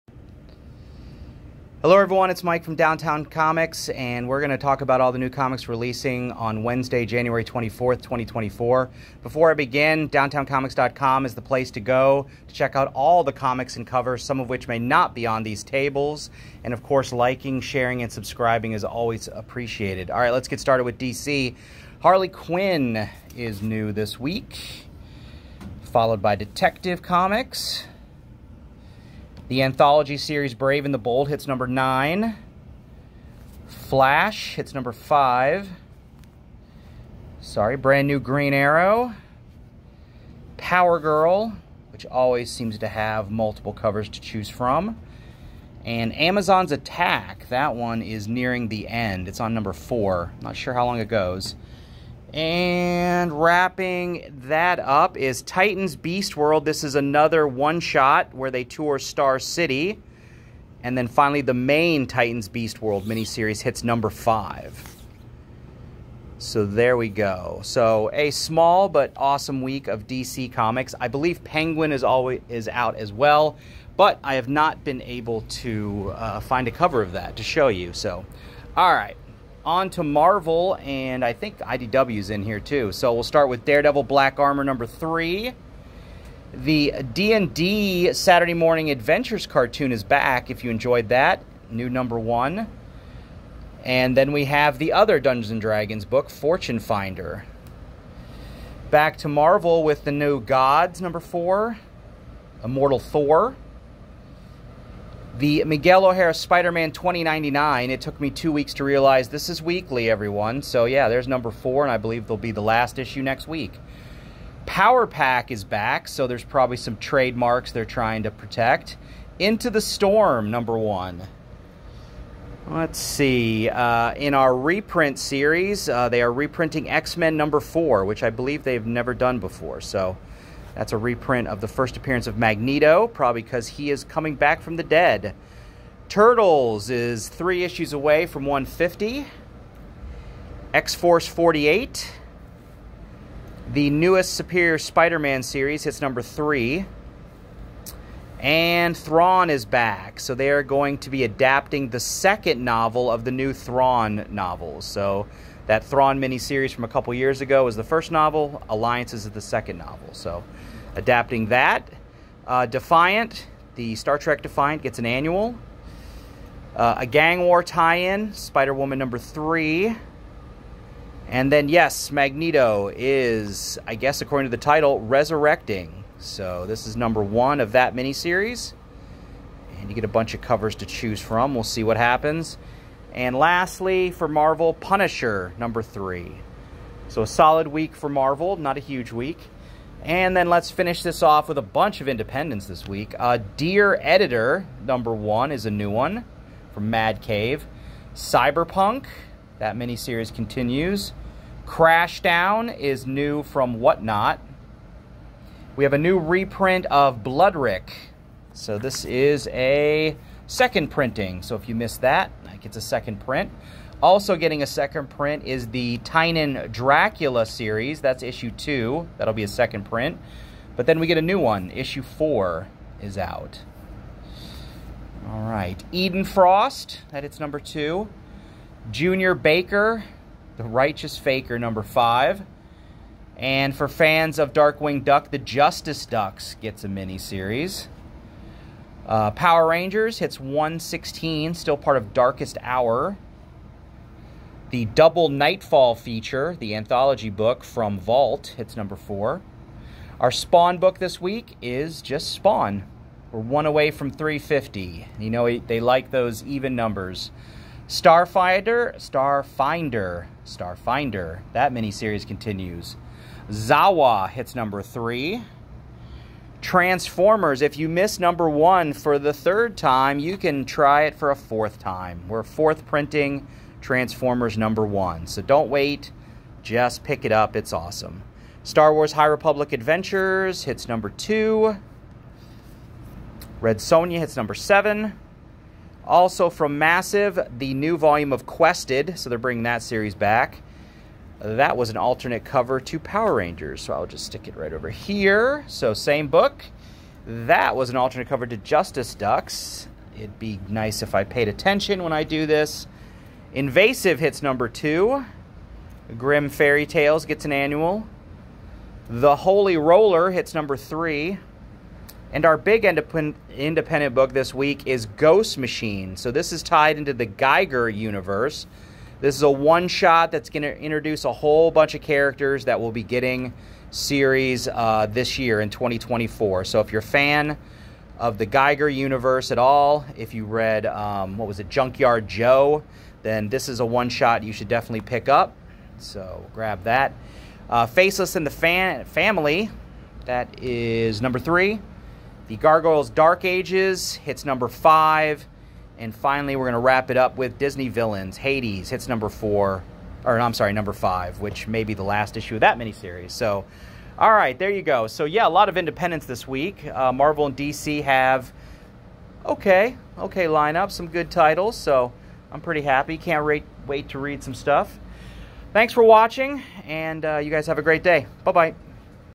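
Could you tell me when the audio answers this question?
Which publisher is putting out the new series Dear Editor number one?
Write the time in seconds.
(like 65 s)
196 s.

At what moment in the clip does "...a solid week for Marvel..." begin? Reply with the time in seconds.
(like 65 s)
187 s.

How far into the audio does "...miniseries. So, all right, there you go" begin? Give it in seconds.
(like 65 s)
352 s.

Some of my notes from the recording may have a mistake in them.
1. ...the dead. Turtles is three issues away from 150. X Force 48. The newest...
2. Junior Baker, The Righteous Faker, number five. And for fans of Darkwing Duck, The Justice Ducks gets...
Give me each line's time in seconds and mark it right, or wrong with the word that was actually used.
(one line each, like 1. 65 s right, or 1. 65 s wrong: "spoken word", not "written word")
1. 134 s right
2. 228 s right.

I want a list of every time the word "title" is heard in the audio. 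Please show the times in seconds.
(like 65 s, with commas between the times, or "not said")
174 s, 361 s.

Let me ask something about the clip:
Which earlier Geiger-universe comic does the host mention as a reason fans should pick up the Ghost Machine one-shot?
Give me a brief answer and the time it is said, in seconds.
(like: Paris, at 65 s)
Junkyard Joe, at 331 s.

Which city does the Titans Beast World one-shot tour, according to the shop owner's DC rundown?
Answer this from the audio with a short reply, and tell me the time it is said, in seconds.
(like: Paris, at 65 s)
Star City, at 58 s.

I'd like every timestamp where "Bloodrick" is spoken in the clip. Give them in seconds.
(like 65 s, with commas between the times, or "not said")
207 s.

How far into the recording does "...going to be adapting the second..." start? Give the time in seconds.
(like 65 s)
150 s.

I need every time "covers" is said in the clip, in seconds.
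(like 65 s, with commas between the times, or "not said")
13 s, 43 s, 76 s, 180 s, 292 s, 298 s.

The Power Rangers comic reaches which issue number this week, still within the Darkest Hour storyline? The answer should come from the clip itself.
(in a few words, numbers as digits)
116.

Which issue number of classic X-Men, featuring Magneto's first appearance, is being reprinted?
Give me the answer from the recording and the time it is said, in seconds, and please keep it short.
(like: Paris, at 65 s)
4, at 126 s.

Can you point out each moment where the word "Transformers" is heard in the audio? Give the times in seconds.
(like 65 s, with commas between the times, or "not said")
266 s, 273 s.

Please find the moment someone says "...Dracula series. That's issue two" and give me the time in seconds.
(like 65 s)
216 s.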